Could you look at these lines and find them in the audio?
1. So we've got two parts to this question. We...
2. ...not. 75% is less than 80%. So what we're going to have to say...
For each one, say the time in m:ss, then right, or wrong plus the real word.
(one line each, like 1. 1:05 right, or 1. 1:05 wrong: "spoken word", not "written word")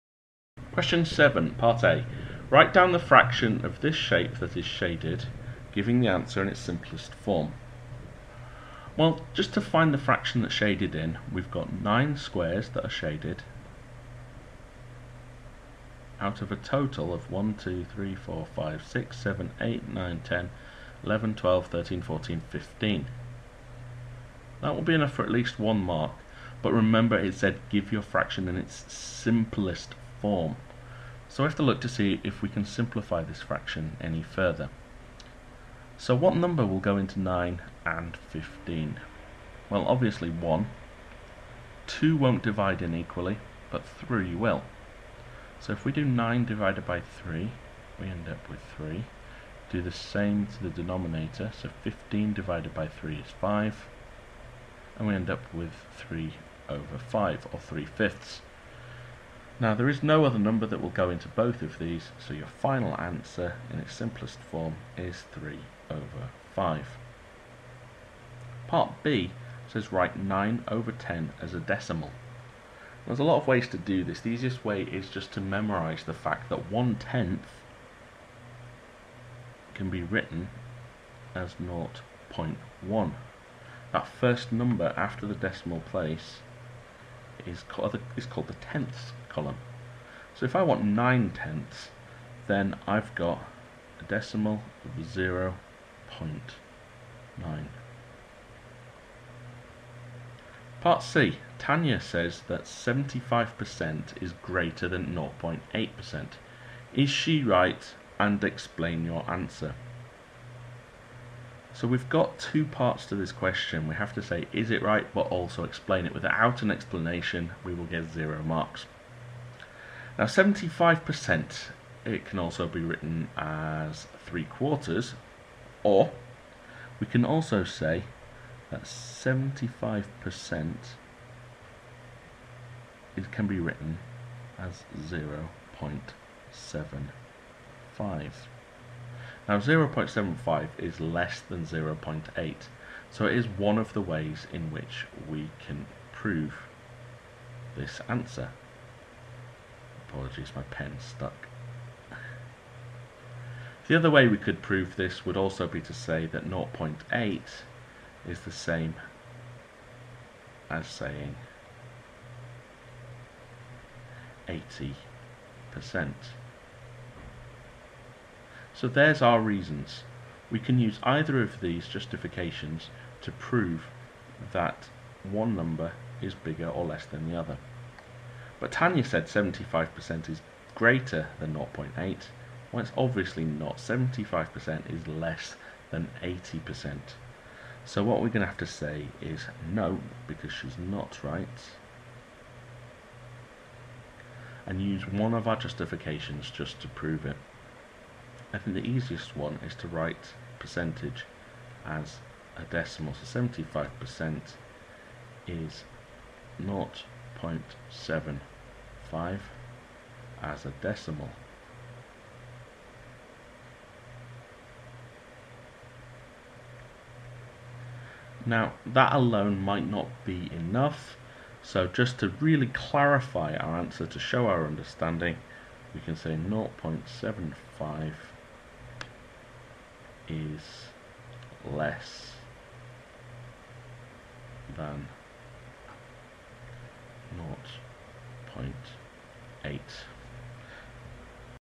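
1. 1:51 right
2. 3:03 right.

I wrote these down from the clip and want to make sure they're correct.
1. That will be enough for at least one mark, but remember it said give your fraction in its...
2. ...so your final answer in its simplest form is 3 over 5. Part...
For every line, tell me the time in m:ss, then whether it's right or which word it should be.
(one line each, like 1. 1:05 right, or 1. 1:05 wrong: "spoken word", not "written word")
1. 0:24 right
2. 1:02 right.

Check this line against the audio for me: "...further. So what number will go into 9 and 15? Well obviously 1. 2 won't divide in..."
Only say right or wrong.
right.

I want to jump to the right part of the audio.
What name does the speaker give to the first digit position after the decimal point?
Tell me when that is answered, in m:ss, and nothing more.
1:28.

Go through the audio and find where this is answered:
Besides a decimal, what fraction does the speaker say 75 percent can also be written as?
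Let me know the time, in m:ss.
2:04.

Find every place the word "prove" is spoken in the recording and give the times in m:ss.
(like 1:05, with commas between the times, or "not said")
2:26, 2:34, 2:53, 3:16.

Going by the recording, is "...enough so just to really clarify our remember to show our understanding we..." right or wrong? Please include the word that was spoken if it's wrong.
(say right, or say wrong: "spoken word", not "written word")
wrong: "answer", not "remember".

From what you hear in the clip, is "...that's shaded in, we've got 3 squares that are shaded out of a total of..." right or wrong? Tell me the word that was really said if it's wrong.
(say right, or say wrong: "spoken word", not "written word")
wrong: "9", not "3".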